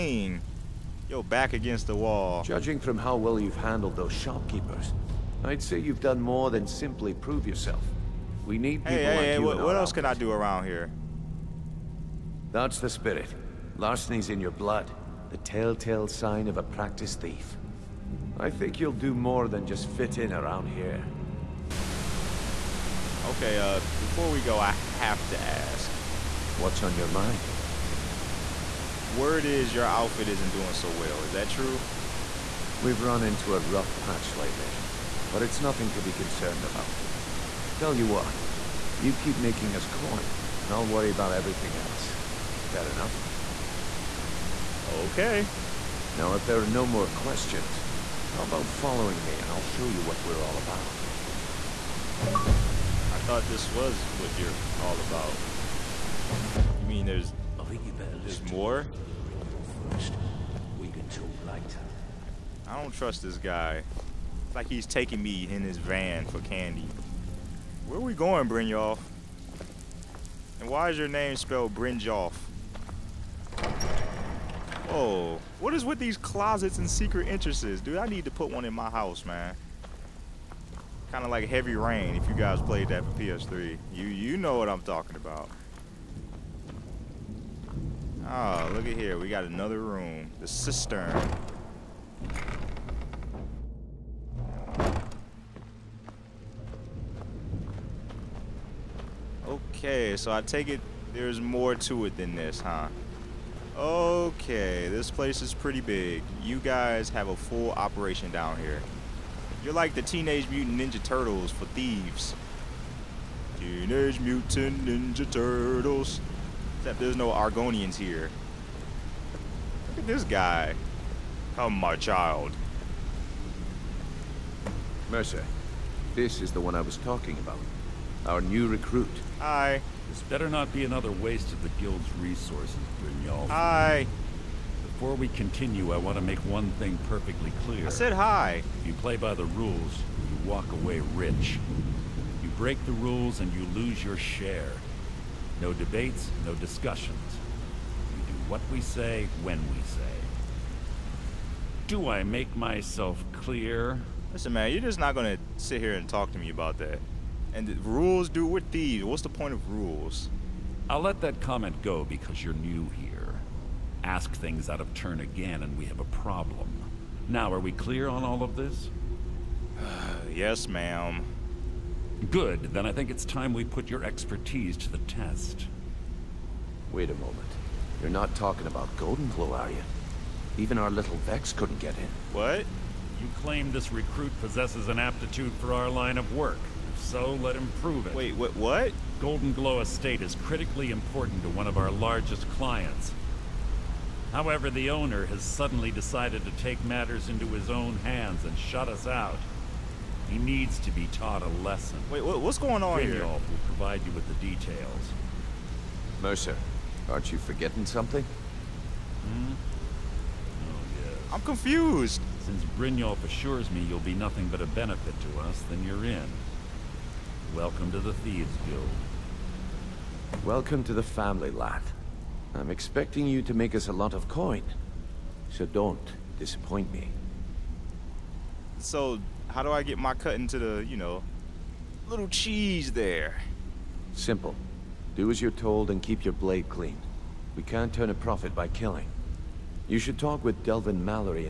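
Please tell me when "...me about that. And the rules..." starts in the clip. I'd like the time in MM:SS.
02:36.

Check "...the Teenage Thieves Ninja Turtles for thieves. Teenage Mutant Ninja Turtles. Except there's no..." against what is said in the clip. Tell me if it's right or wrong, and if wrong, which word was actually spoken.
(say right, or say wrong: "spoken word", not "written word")
wrong: "Mutant", not "Thieves".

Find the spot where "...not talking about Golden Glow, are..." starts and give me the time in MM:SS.
02:58.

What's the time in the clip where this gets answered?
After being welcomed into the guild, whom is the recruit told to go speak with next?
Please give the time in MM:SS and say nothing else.
04:00.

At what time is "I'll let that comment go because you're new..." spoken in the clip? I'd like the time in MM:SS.
02:40.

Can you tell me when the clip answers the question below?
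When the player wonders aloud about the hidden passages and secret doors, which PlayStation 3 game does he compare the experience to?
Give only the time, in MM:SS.
01:21.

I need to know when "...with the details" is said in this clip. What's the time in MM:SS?
03:24.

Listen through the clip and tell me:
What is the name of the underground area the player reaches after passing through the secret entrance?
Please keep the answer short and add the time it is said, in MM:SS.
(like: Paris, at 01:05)
The Cistern, at 01:30.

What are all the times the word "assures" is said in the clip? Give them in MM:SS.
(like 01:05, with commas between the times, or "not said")
03:33.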